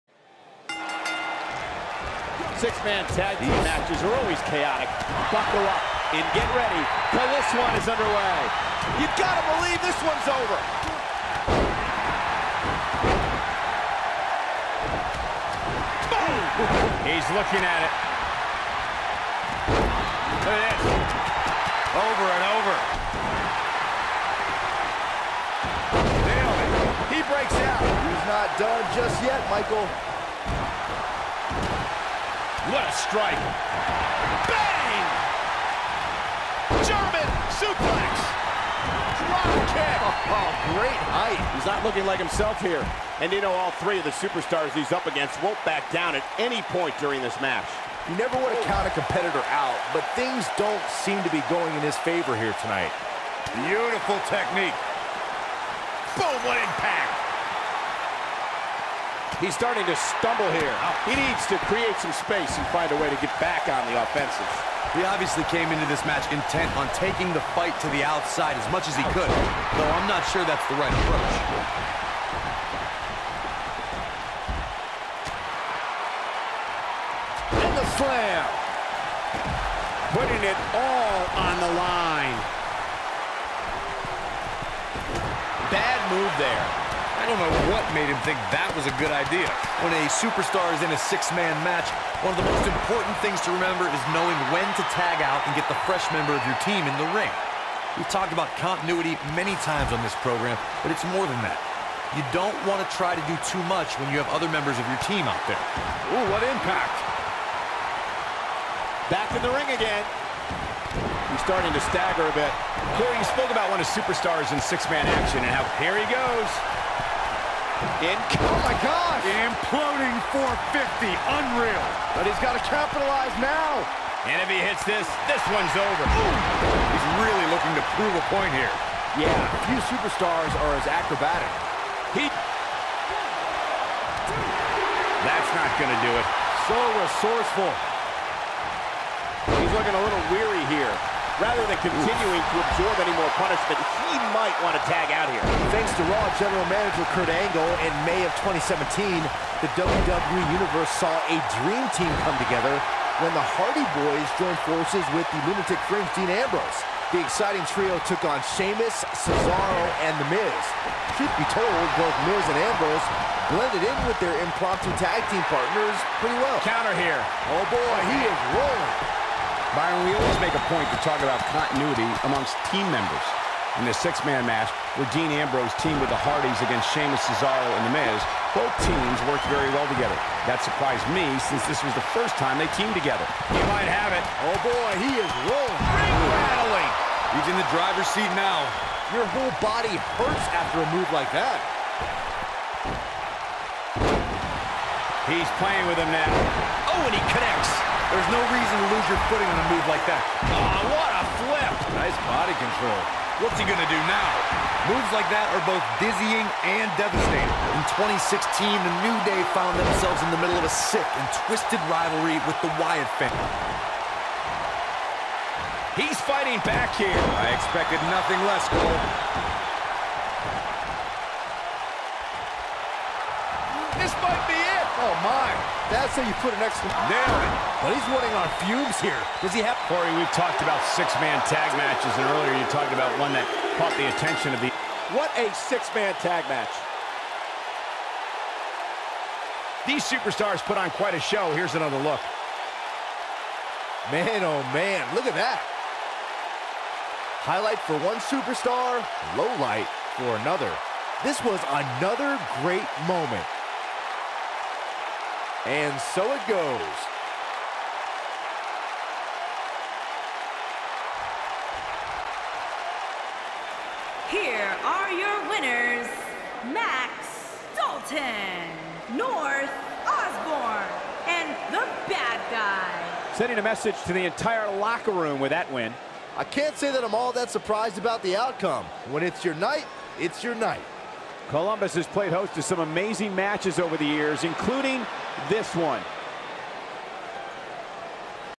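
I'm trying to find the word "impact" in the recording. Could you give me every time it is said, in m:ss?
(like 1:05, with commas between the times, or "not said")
0:56, 1:46.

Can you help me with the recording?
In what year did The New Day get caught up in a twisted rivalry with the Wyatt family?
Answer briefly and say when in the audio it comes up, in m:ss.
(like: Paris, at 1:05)
2016, at 3:27.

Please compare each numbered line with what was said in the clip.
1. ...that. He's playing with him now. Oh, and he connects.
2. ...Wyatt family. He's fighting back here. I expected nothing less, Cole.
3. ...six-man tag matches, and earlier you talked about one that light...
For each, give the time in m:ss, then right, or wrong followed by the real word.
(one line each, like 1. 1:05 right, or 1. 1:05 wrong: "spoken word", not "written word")
1. 3:11 right
2. 3:32 right
3. 3:50 wrong: "caught", not "light".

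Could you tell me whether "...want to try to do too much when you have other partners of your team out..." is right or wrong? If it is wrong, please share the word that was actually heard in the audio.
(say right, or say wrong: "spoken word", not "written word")
wrong: "members", not "partners".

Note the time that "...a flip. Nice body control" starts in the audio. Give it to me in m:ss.
3:21.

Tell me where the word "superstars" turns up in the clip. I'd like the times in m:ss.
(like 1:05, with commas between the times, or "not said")
0:44, 1:30, 1:53, 2:09, 4:00, 4:08.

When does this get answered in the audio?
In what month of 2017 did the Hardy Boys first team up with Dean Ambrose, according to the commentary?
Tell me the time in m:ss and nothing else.
2:28.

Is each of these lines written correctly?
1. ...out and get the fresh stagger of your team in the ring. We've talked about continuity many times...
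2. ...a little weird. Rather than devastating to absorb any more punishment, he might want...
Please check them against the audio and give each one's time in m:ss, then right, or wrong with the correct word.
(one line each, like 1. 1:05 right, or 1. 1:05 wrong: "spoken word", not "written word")
1. 1:35 wrong: "member", not "stagger"
2. 2:19 wrong: "continuing", not "devastating".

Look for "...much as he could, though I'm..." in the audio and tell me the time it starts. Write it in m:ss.
1:08.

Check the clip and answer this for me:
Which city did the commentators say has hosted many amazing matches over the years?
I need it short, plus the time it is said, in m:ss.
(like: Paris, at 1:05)
Columbus, at 4:41.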